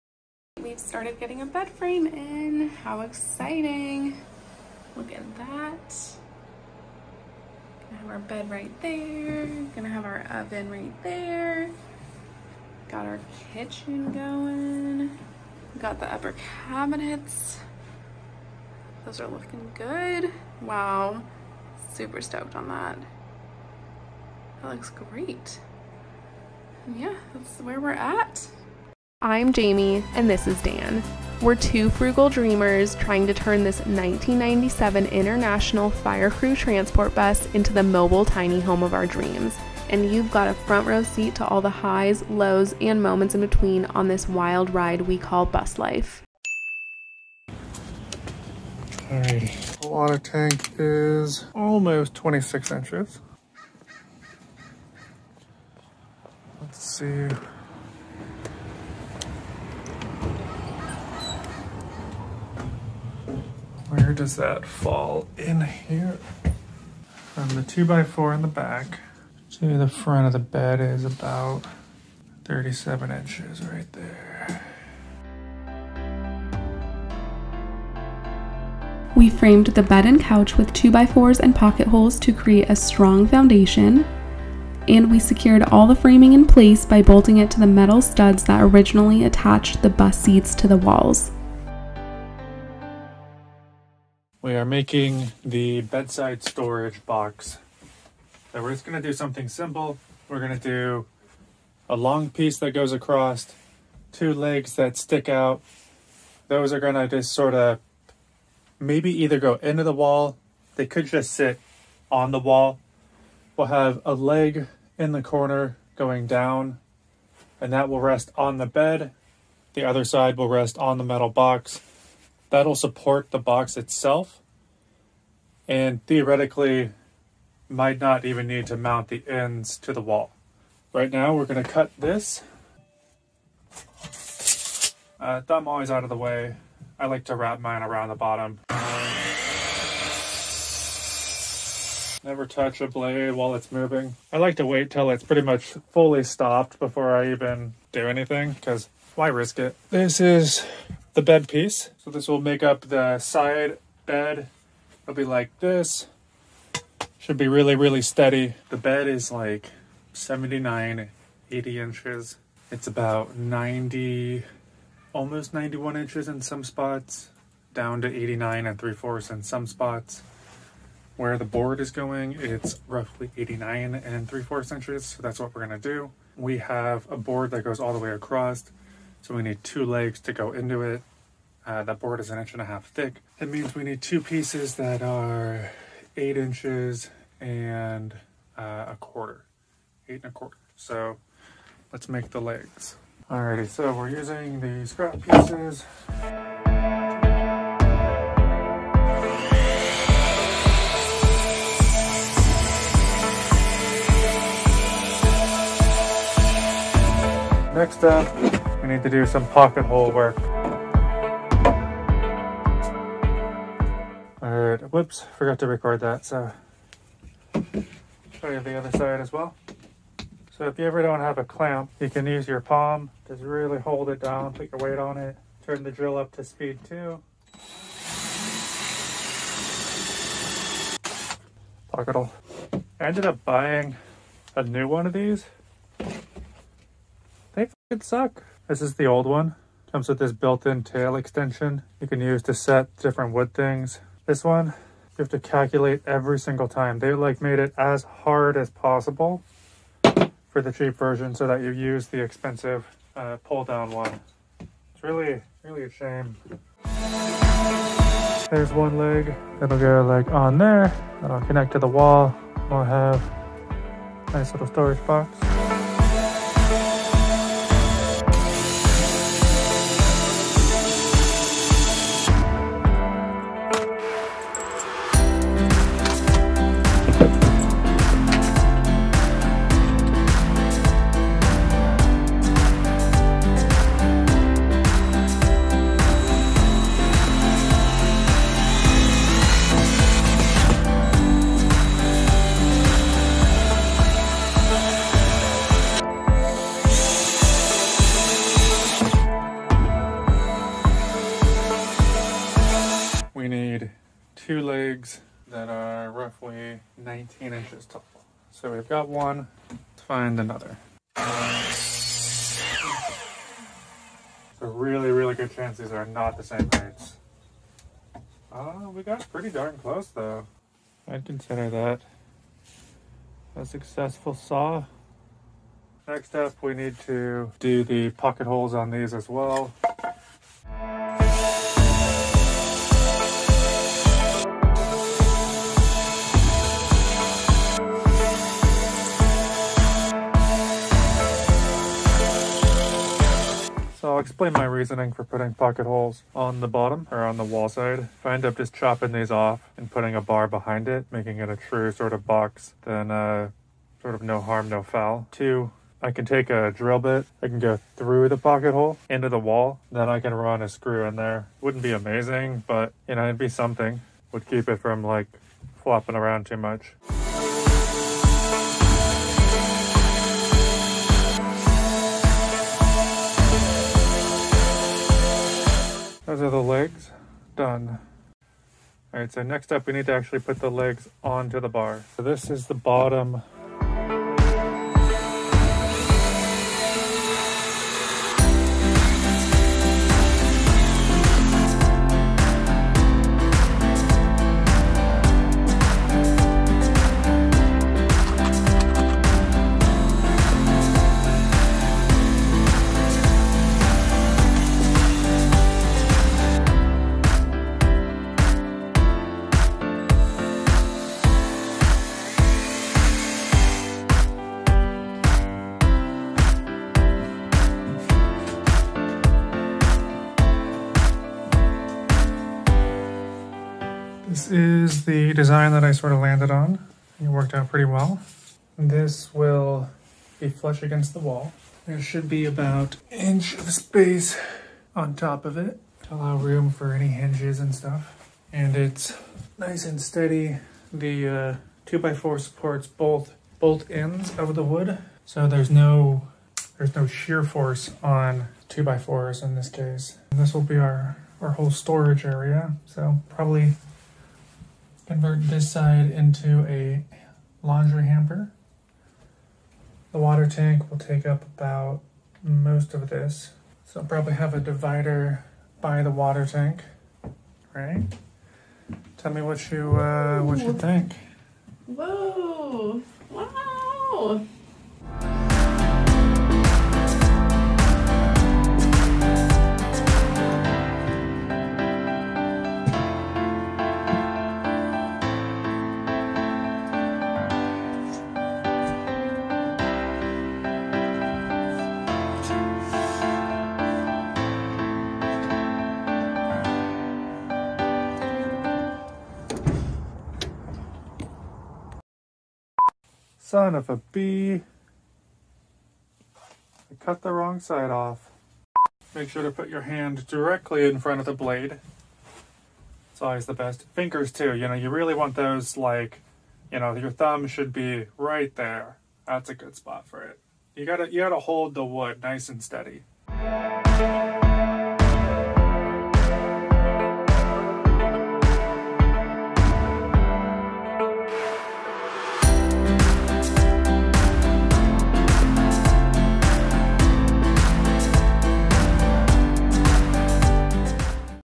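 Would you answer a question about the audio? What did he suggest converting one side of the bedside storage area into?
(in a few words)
laundry hamper.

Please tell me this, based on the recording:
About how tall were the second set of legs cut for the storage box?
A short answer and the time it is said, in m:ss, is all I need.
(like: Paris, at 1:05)
19 inches, at 5:06.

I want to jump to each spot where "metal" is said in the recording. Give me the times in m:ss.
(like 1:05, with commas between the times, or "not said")
1:27, 2:01.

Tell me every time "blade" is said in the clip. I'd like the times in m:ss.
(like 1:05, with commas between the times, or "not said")
2:22, 8:31.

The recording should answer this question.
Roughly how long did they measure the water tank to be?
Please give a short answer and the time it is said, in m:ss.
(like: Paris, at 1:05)
almost 26 inches, at 0:51.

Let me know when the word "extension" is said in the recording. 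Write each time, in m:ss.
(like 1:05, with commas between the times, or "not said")
4:01.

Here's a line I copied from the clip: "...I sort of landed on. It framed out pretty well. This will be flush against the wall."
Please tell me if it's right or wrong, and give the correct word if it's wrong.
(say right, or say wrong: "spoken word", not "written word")
wrong: "worked", not "framed".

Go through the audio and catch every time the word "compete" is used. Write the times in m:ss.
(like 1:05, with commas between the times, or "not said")
not said.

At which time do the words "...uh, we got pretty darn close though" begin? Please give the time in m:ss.
5:18.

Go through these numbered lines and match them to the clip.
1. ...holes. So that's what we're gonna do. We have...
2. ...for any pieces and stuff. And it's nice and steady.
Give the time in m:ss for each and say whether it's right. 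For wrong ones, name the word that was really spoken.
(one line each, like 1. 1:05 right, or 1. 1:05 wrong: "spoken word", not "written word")
1. 2:54 wrong: "inches", not "holes"
2. 7:16 wrong: "hinges", not "pieces".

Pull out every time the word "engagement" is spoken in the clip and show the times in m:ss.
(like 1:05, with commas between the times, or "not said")
not said.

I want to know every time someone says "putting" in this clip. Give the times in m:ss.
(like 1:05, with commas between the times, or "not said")
5:45, 5:49.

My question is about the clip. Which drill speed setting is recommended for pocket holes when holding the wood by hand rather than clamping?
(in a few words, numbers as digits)
speed two.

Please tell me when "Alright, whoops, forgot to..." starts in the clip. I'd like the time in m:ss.
3:34.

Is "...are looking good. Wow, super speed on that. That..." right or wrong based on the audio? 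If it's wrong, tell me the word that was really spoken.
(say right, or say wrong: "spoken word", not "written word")
wrong: "stoked", not "speed".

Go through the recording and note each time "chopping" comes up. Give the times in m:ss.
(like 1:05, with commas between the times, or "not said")
5:48.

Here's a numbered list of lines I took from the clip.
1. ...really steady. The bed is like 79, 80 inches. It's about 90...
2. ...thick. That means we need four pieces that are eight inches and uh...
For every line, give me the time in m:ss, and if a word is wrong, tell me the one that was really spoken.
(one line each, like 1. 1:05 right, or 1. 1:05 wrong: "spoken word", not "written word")
1. 2:37 right
2. 3:02 wrong: "two", not "four".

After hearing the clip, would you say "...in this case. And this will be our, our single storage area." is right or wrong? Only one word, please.
wrong.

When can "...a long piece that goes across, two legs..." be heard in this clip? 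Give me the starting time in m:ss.
1:41.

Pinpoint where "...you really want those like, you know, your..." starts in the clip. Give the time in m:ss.
8:34.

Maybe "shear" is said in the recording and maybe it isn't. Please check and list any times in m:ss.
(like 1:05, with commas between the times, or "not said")
7:27.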